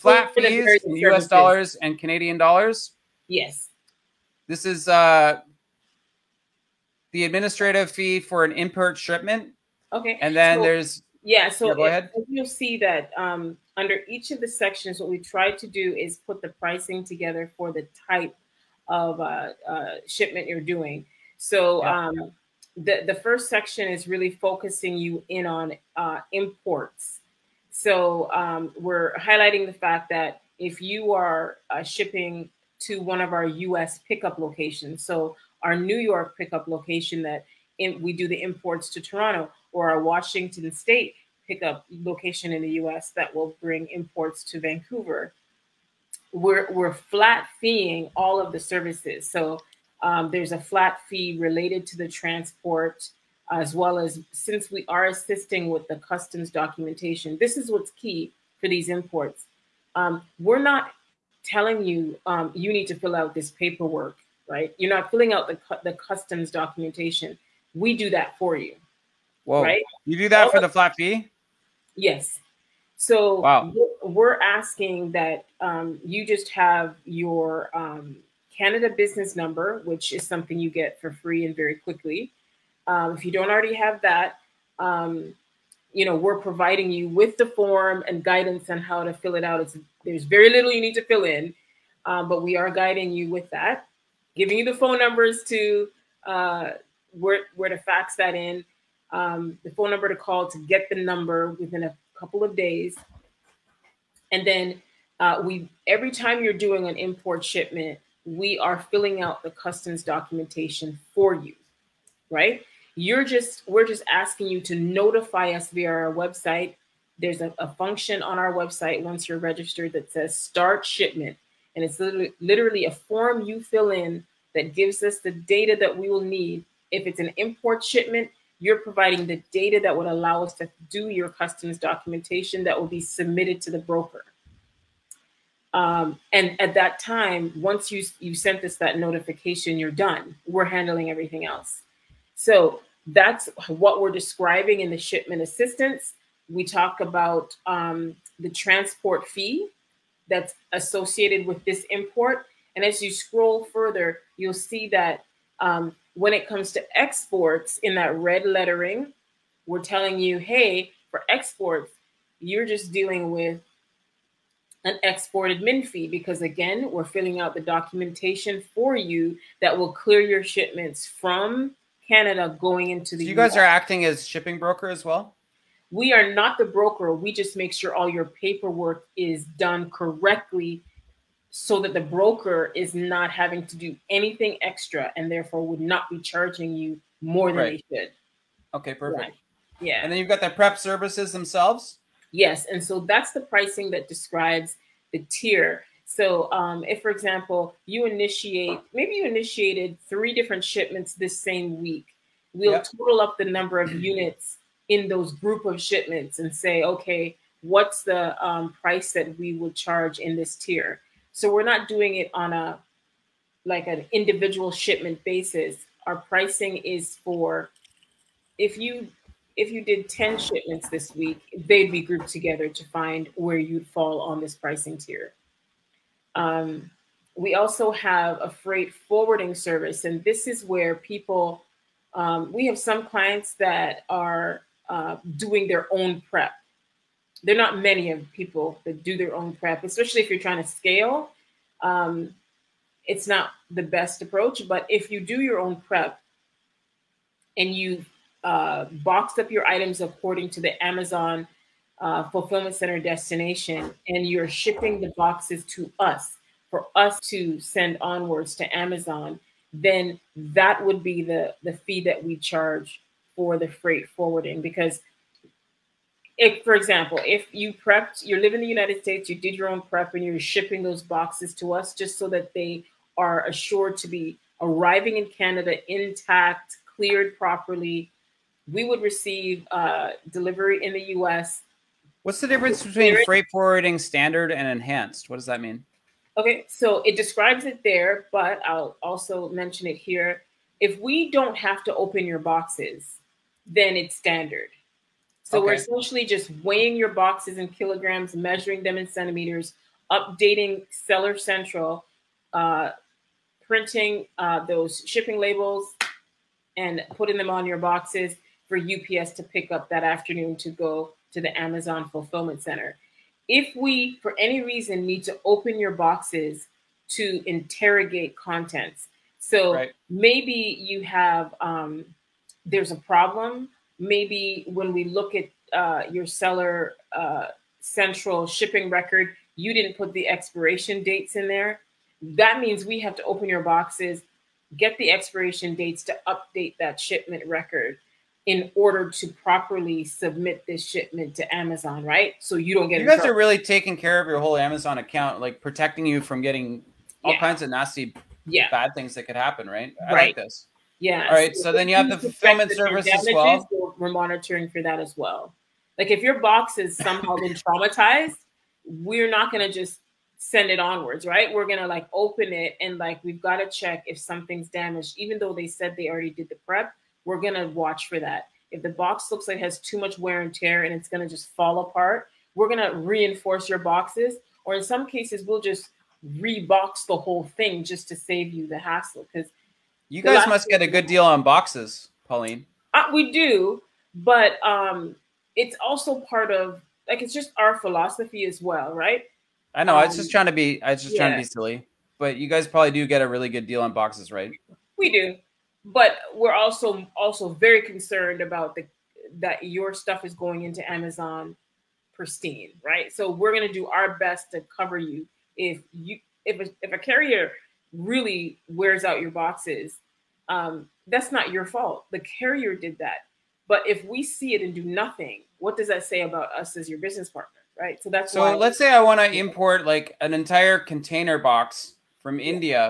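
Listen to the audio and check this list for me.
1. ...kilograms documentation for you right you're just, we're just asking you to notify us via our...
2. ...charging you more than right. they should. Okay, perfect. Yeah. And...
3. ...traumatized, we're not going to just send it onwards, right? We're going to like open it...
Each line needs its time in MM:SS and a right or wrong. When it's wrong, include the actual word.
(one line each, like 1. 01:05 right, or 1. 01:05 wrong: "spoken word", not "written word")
1. 01:49 wrong: "customs", not "kilograms"
2. 03:06 right
3. 05:57 right.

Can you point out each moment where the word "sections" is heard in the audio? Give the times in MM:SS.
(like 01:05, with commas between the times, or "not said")
00:14, 00:23.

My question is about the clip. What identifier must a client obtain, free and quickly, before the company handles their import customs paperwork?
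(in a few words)
Canada business number.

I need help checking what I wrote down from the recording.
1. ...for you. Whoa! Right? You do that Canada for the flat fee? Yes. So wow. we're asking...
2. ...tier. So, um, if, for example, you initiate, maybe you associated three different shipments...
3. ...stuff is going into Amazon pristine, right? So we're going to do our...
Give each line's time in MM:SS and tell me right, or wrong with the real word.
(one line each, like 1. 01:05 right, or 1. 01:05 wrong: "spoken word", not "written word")
1. 01:08 wrong: "All", not "Canada"
2. 03:15 wrong: "initiated", not "associated"
3. 06:39 right.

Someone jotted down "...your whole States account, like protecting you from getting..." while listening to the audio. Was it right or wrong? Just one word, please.
wrong.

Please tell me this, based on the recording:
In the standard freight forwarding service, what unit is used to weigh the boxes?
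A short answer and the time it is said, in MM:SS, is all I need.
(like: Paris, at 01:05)
Kilograms, at 04:57.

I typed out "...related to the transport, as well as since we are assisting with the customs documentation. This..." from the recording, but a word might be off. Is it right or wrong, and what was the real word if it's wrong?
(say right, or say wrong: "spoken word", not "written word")
right.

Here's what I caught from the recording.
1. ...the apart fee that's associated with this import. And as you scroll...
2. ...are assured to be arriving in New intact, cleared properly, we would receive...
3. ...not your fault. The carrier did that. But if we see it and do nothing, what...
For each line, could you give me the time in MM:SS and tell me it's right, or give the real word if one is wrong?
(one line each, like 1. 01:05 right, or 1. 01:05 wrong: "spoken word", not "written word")
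1. 02:28 wrong: "transport", not "apart"
2. 04:33 wrong: "Canada", not "New"
3. 06:51 right.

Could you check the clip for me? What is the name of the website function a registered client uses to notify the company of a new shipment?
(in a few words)
Start shipment.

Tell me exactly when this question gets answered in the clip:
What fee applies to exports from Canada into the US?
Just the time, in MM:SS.
02:45.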